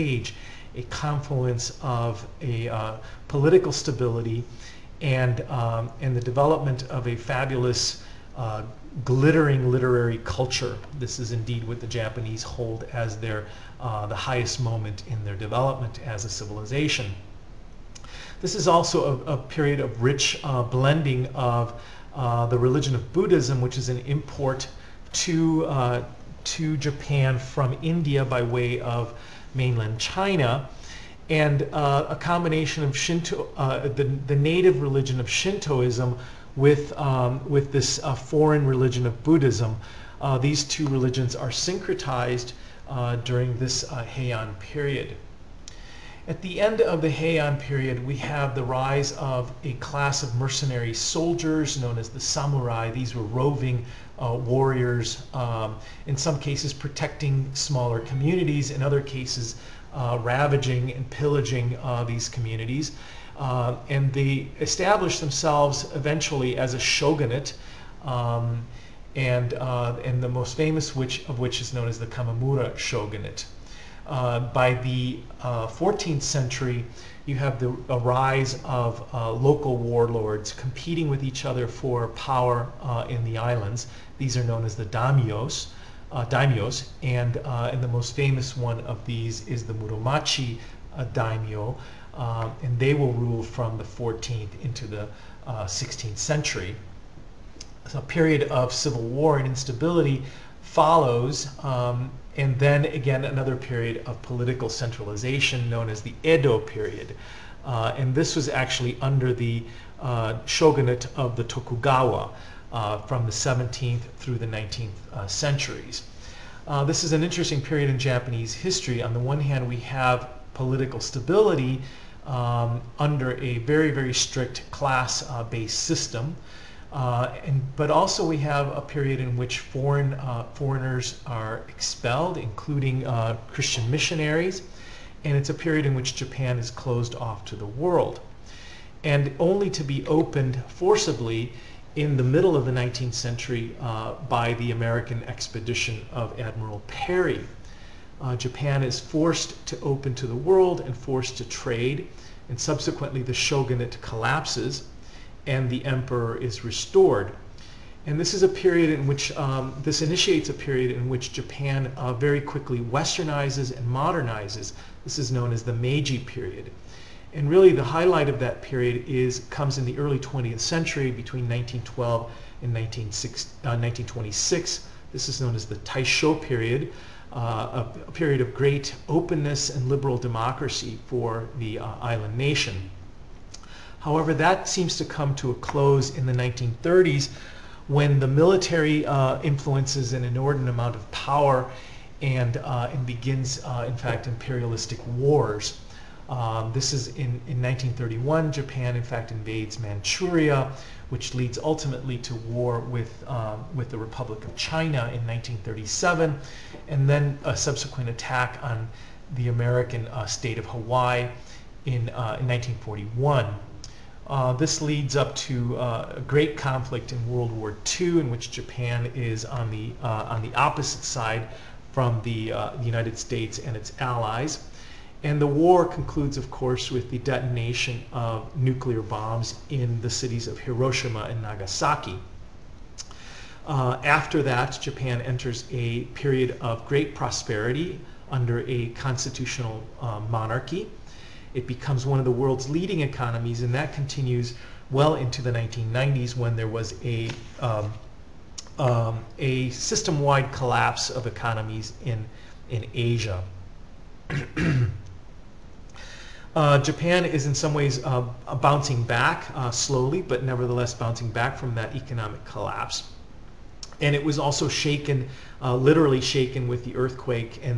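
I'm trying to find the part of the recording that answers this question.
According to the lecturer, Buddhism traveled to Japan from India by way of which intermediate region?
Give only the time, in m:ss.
0:29.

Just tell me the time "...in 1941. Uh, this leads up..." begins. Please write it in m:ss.
3:32.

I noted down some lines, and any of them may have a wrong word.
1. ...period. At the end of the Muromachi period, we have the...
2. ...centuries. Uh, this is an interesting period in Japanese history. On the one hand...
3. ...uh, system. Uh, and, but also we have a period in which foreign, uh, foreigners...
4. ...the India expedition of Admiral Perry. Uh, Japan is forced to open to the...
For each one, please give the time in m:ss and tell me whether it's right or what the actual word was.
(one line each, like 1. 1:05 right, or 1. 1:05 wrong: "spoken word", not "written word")
1. 0:44 wrong: "Heian", not "Muromachi"
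2. 1:55 right
3. 2:05 right
4. 2:24 wrong: "American", not "India".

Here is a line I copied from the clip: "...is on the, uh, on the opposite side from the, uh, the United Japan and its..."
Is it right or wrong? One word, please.
wrong.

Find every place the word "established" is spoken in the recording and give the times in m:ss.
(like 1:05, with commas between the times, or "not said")
1:04.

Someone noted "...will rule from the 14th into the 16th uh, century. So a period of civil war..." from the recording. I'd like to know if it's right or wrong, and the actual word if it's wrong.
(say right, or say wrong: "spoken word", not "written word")
right.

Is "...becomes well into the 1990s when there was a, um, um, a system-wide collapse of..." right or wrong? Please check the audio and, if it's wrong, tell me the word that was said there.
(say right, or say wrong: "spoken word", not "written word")
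wrong: "continues", not "becomes".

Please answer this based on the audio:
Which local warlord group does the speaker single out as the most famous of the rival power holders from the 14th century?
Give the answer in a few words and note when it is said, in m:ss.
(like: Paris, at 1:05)
Muromachi, at 1:29.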